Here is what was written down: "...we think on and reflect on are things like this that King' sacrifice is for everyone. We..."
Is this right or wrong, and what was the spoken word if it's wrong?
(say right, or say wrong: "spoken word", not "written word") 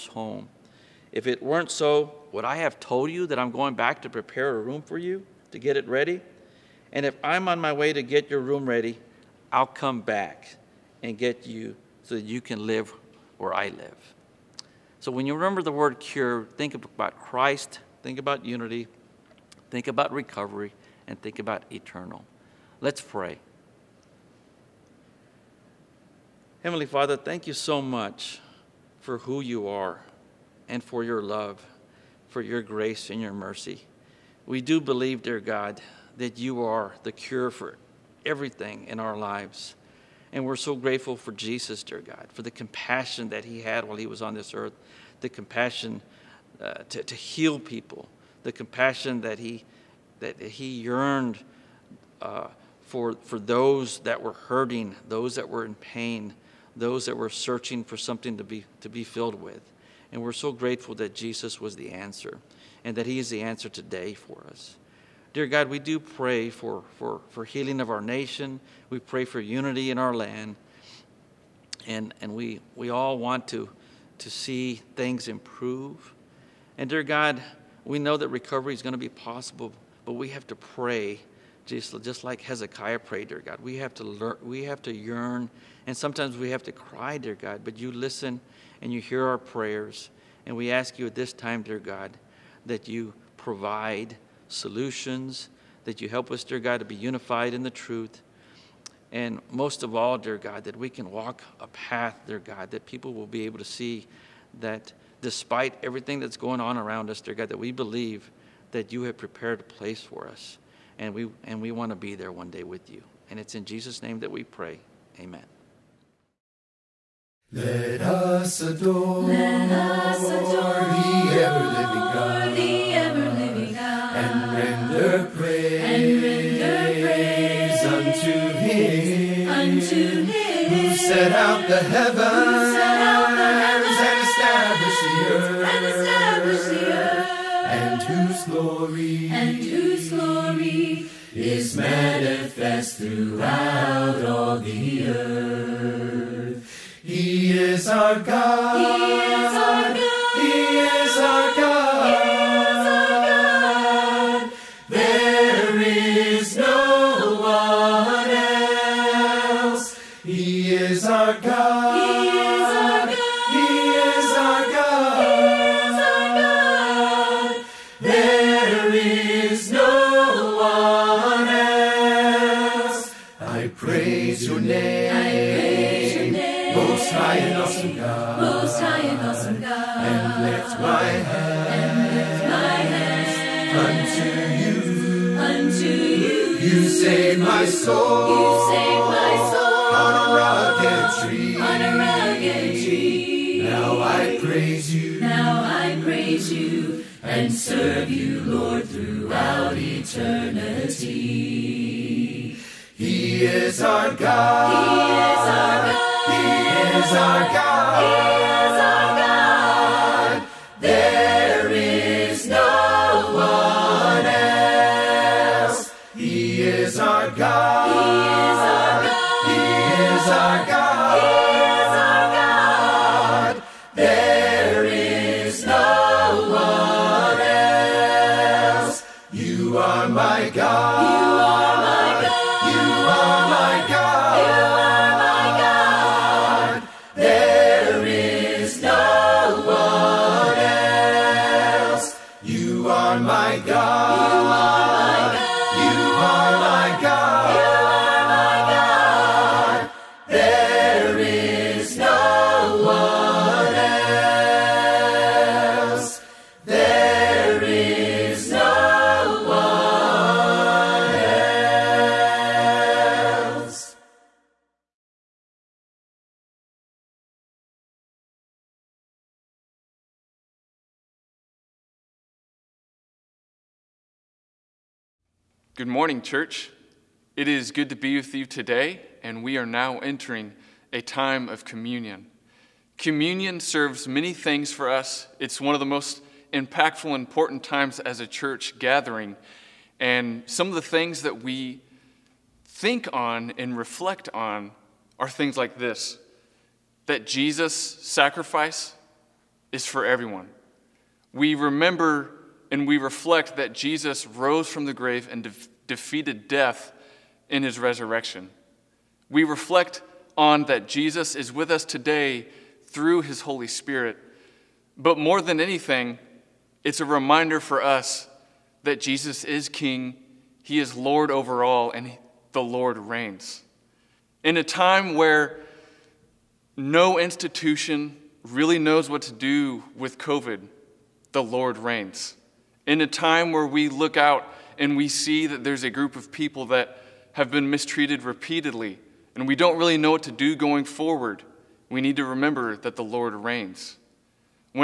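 wrong: "Jesus", not "King".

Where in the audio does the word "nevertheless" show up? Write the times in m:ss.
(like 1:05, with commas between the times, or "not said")
not said.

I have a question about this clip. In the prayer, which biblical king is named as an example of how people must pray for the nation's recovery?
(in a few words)
Hezekiah.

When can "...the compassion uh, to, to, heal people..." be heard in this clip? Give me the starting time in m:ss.
0:45.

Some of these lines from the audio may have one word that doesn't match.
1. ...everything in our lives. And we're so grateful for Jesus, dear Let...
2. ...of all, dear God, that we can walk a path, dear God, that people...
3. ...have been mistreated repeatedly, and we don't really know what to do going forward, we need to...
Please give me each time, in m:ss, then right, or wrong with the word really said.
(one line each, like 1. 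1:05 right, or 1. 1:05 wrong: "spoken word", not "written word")
1. 0:38 wrong: "God", not "Let"
2. 1:39 right
3. 5:37 right.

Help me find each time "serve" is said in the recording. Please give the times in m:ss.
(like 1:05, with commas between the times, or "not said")
3:17, 4:43.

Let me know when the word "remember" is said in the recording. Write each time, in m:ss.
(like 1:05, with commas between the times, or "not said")
0:15, 5:01, 5:42.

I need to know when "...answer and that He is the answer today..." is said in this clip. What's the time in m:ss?
1:01.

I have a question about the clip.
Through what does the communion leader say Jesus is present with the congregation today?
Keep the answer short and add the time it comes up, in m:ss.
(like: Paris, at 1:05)
his Holy Spirit, at 5:13.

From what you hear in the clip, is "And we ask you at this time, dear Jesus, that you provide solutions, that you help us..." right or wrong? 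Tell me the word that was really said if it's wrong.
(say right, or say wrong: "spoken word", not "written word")
wrong: "God", not "Jesus".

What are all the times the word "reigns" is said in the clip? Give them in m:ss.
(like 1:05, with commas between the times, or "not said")
5:22, 5:31, 5:43.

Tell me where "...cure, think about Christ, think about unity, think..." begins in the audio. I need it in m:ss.
0:15.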